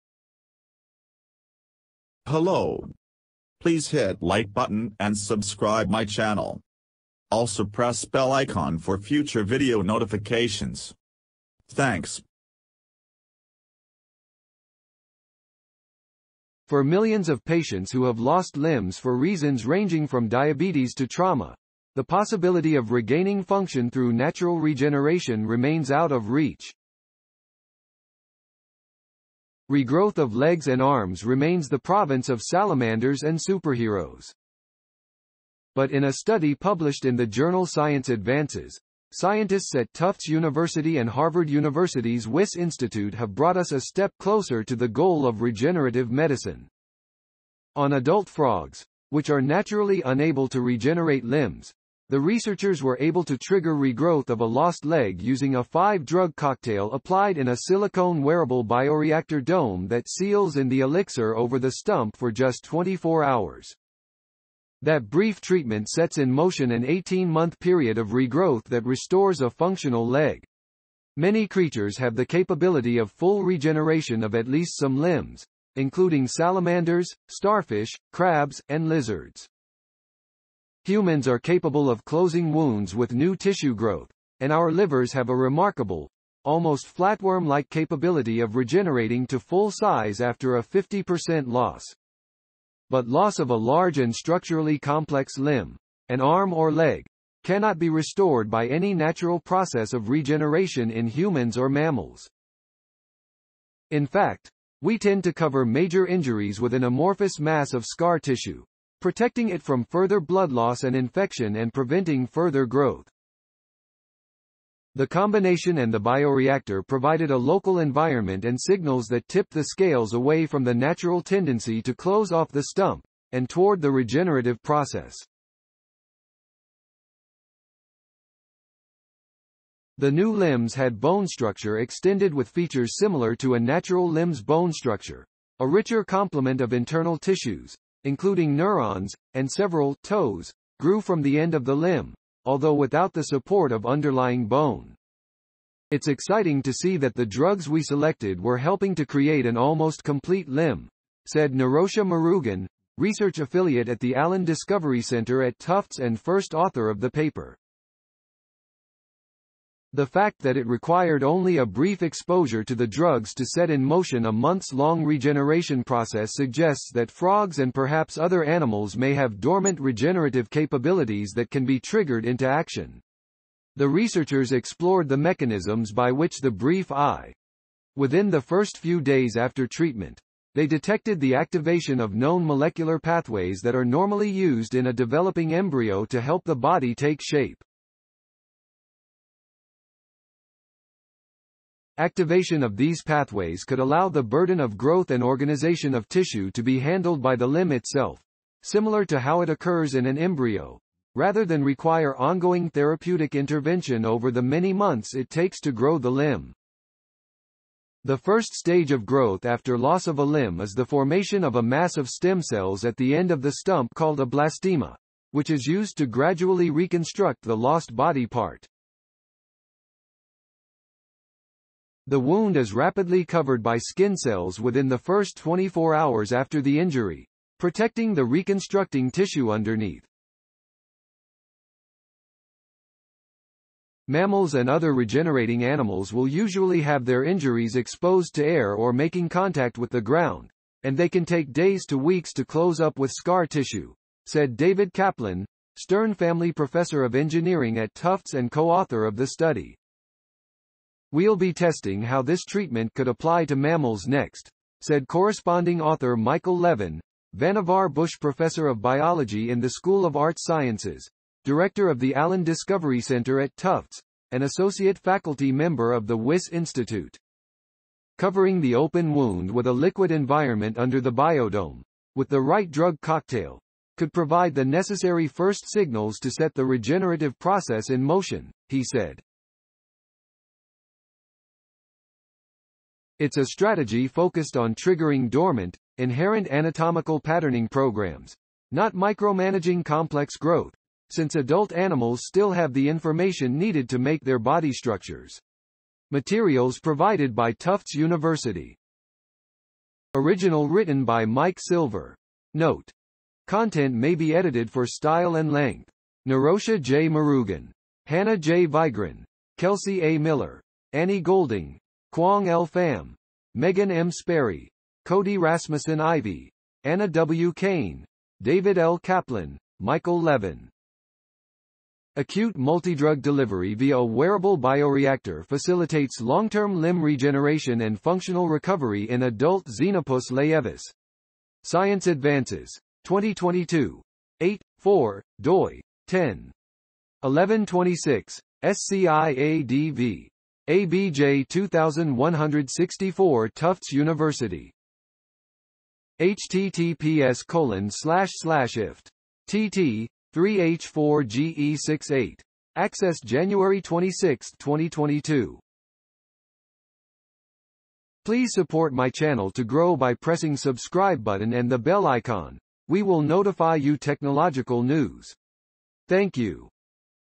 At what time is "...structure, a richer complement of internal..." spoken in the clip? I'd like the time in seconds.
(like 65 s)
134 s.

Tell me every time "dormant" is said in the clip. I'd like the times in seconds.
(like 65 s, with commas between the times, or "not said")
169 s, 285 s.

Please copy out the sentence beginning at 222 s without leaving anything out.
The wound is rapidly covered by skin cells within the first 24 hours after the injury, protecting the reconstructing tissue underneath.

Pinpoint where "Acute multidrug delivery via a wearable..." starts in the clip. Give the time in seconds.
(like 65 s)
322 s.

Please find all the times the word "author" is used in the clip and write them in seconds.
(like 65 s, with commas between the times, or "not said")
156 s, 248 s, 255 s.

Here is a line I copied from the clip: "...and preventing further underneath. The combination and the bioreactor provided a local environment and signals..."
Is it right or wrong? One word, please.
wrong.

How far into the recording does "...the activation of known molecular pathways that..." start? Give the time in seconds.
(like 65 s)
181 s.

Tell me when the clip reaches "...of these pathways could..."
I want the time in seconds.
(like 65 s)
192 s.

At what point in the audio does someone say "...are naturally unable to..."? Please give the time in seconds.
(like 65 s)
49 s.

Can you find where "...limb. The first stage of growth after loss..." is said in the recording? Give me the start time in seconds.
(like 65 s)
206 s.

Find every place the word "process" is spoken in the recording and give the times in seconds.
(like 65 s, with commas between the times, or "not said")
99 s, 124 s, 165 s, 277 s.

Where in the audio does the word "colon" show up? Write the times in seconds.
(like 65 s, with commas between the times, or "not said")
347 s.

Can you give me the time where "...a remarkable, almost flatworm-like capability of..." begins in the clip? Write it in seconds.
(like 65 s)
85 s.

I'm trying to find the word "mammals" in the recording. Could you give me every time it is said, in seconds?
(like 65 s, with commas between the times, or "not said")
101 s, 234 s, 253 s.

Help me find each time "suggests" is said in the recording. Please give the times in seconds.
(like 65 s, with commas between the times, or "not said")
166 s.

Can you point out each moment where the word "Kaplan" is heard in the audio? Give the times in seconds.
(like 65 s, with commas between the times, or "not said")
244 s, 318 s.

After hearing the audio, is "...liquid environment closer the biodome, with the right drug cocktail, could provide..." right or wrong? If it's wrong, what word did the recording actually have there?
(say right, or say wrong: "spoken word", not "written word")
wrong: "under", not "closer".